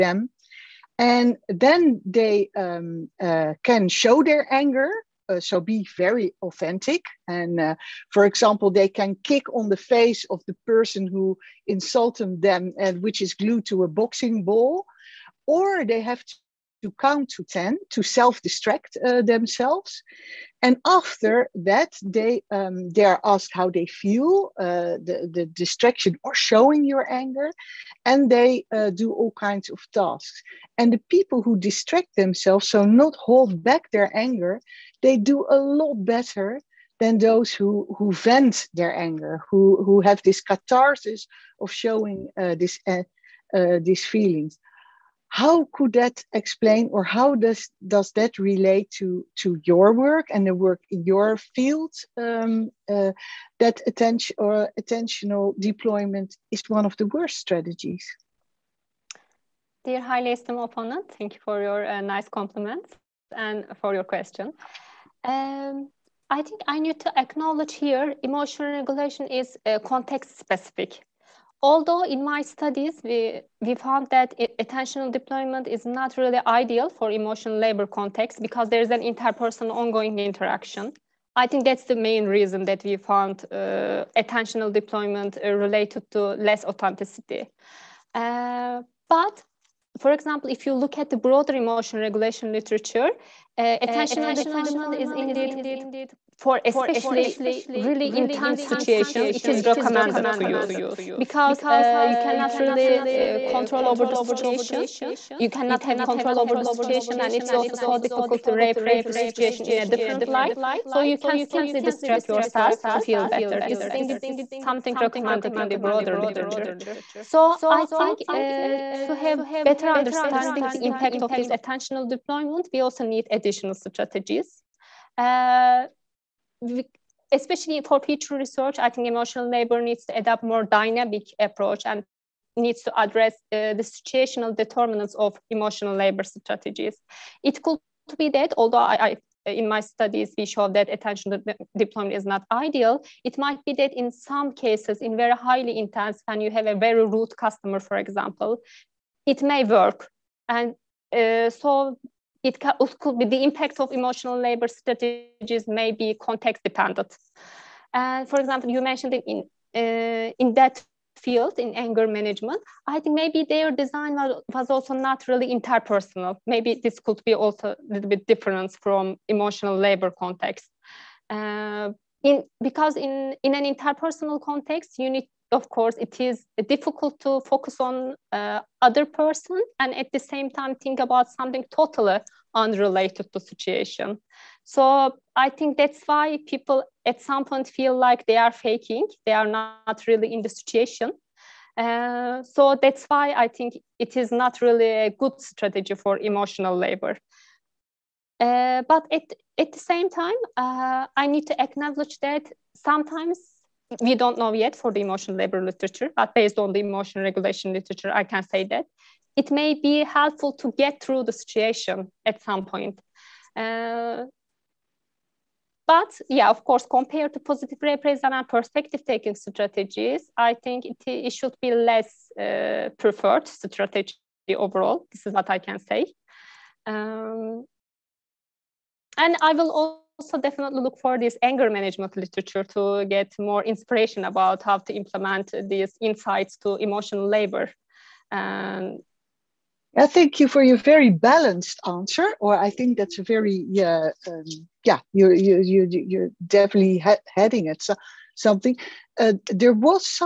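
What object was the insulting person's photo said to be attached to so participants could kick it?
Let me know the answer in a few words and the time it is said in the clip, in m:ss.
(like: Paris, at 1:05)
boxing ball, at 0:13.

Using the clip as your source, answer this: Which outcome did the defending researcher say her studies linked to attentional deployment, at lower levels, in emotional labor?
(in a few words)
authenticity.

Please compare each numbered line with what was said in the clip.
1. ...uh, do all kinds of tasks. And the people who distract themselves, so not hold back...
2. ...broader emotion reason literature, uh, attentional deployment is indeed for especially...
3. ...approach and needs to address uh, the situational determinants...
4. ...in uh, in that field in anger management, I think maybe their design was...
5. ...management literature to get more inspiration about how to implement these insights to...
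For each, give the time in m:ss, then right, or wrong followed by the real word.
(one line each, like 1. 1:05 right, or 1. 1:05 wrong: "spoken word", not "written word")
1. 0:28 right
2. 1:31 wrong: "regulation", not "reason"
3. 2:11 right
4. 2:39 right
5. 3:51 right.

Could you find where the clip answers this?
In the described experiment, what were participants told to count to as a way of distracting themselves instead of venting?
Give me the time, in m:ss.
0:17.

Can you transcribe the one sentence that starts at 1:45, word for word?
You cannot have control over the situation, and it's also so difficult to reappraise the situation in a different light.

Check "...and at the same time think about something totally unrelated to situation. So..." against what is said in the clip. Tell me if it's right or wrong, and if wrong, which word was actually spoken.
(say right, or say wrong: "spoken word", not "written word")
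right.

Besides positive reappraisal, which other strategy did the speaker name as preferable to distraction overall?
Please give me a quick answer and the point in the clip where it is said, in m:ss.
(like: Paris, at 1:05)
perspective taking, at 3:38.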